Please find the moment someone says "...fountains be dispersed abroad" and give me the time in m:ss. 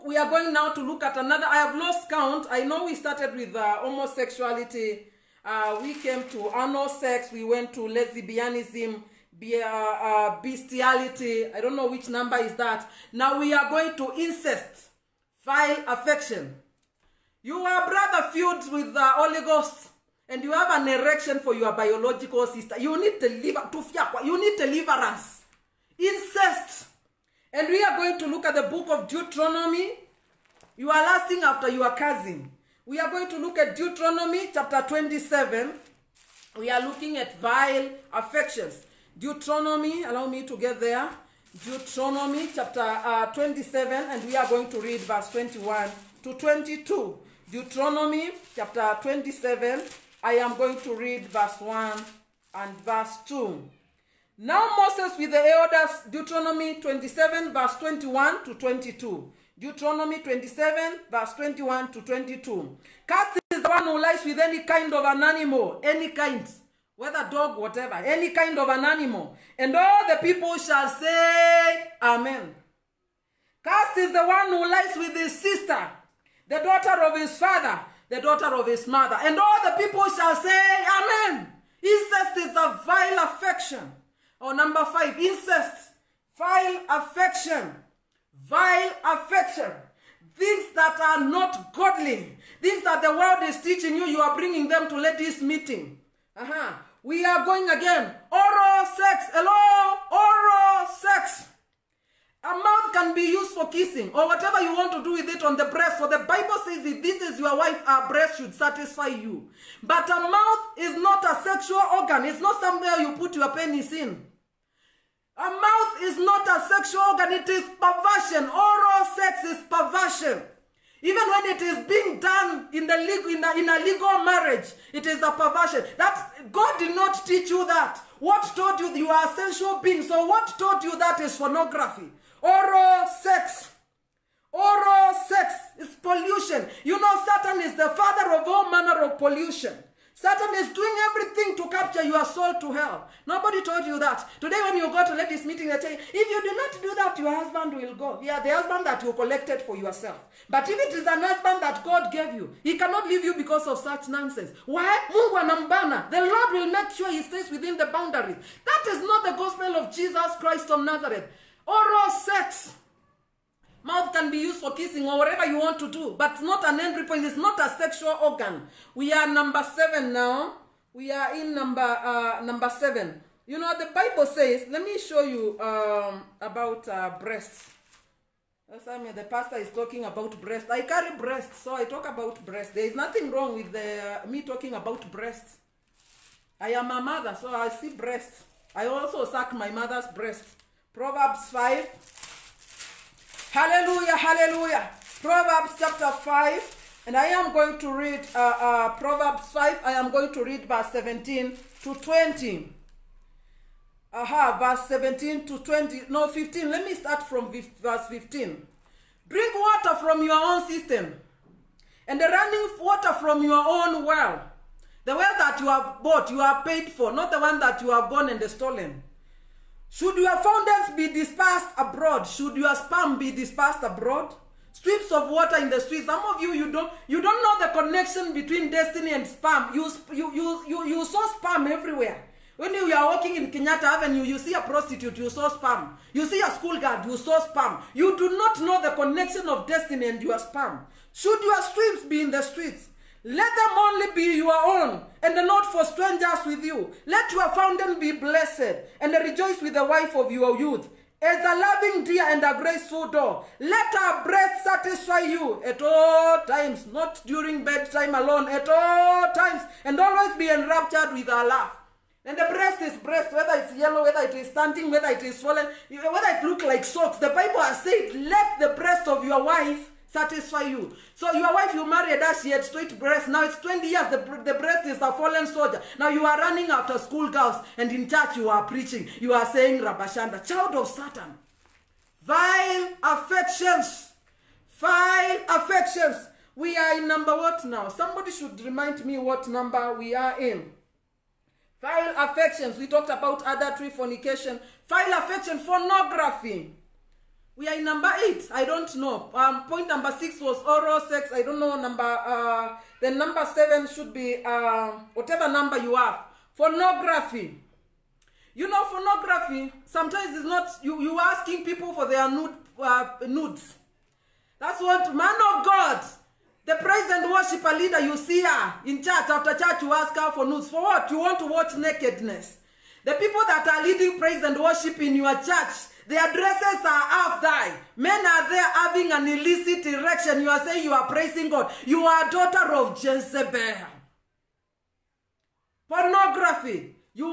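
3:40.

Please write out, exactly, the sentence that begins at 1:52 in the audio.
It's not somewhere you put your penis in.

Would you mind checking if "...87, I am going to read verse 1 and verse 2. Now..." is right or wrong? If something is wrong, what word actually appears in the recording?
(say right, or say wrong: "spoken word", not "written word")
wrong: "27", not "87".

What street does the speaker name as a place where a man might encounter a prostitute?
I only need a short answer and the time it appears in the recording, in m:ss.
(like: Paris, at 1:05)
Kenyatta Avenue, at 3:53.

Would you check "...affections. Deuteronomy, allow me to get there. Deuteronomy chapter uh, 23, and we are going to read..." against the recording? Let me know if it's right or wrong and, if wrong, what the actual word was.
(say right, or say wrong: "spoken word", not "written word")
wrong: "27", not "23".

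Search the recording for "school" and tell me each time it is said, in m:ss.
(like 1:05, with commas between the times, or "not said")
3:56, 4:36.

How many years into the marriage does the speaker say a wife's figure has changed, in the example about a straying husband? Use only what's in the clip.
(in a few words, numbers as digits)
20 years.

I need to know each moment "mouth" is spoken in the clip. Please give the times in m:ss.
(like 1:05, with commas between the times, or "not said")
1:42, 1:50, 1:55, 2:43.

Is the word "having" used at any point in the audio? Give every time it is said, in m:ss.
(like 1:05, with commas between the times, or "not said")
5:28.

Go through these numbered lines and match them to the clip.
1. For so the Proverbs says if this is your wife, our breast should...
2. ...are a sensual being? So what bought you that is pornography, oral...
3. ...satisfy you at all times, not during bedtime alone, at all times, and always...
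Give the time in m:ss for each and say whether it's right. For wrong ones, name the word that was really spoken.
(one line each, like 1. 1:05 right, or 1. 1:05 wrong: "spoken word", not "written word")
1. 1:45 wrong: "Bible", not "Proverbs"
2. 2:09 wrong: "taught", not "bought"
3. 4:14 right.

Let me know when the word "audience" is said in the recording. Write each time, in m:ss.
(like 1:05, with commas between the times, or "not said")
not said.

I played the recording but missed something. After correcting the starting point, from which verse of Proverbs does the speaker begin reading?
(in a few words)
Verse 15.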